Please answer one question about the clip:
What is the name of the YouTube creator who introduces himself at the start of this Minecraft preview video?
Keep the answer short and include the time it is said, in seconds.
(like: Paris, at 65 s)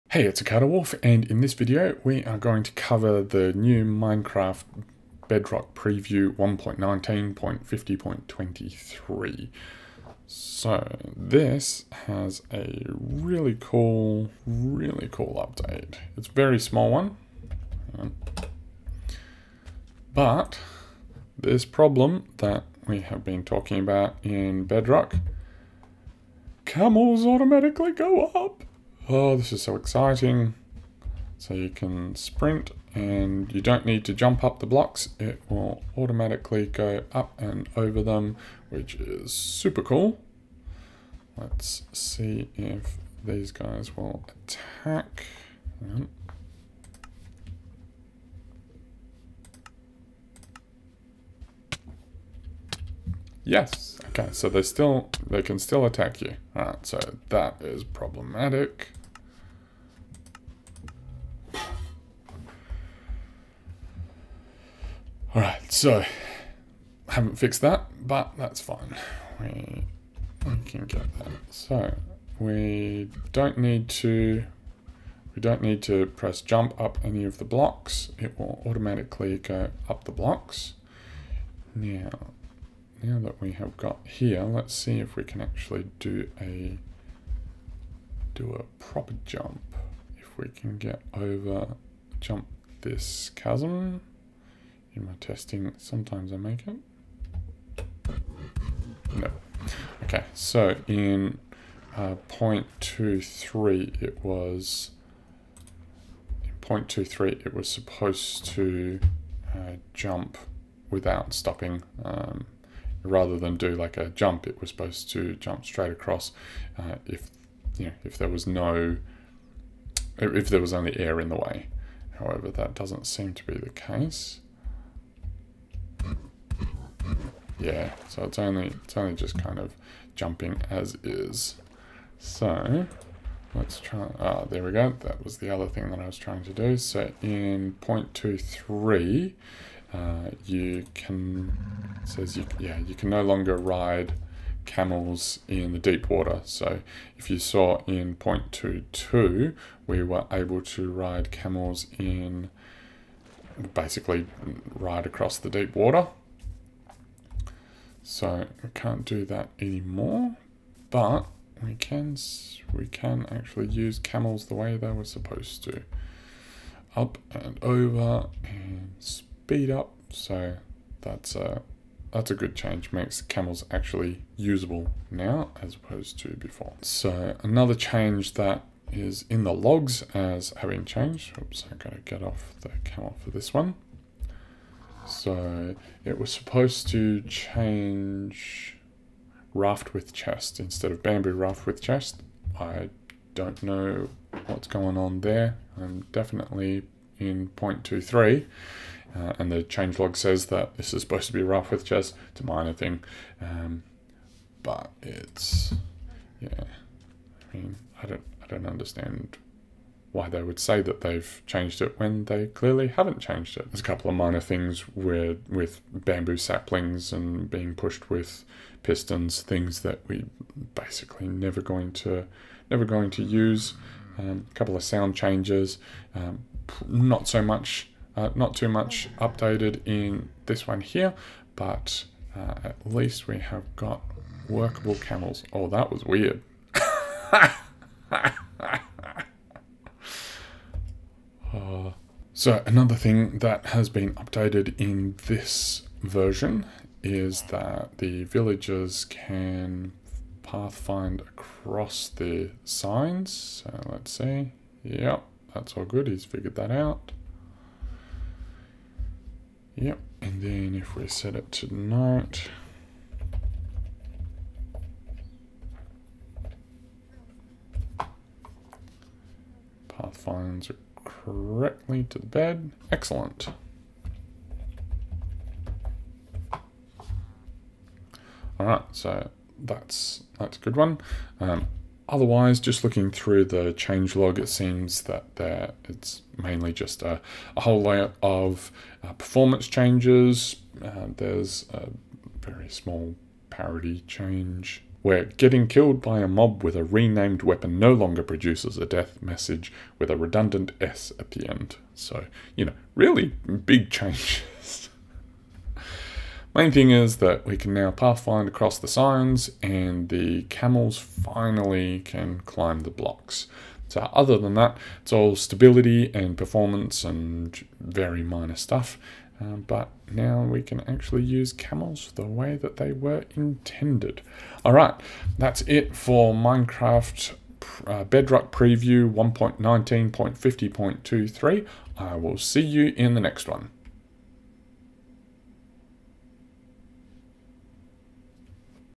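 Acadewolf, at 0 s.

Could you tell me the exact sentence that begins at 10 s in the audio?
So this has a really cool, really cool update.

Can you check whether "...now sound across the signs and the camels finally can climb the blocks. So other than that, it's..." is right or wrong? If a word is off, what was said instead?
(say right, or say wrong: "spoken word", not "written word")
wrong: "pathfind", not "sound".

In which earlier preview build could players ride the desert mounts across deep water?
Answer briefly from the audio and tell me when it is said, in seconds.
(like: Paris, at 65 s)
0.22, at 148 s.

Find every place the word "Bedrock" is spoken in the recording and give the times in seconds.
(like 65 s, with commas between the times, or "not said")
5 s, 24 s, 328 s.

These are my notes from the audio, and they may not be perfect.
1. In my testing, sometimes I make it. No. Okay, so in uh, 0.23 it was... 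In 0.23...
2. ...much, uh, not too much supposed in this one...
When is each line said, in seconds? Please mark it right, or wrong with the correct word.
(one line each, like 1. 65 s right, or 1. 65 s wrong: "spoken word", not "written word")
1. 94 s right
2. 227 s wrong: "updated", not "supposed".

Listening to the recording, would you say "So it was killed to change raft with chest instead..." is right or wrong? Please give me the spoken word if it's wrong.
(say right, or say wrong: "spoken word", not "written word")
wrong: "supposed", not "killed".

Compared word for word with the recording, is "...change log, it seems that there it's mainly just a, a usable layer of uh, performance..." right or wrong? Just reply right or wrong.
wrong.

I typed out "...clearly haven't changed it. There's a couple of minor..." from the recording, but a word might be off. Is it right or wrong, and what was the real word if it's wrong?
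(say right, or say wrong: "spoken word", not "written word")
right.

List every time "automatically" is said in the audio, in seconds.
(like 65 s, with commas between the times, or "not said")
27 s, 35 s, 78 s.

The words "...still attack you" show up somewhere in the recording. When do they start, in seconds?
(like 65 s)
55 s.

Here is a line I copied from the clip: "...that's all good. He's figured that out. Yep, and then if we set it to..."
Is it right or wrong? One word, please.
right.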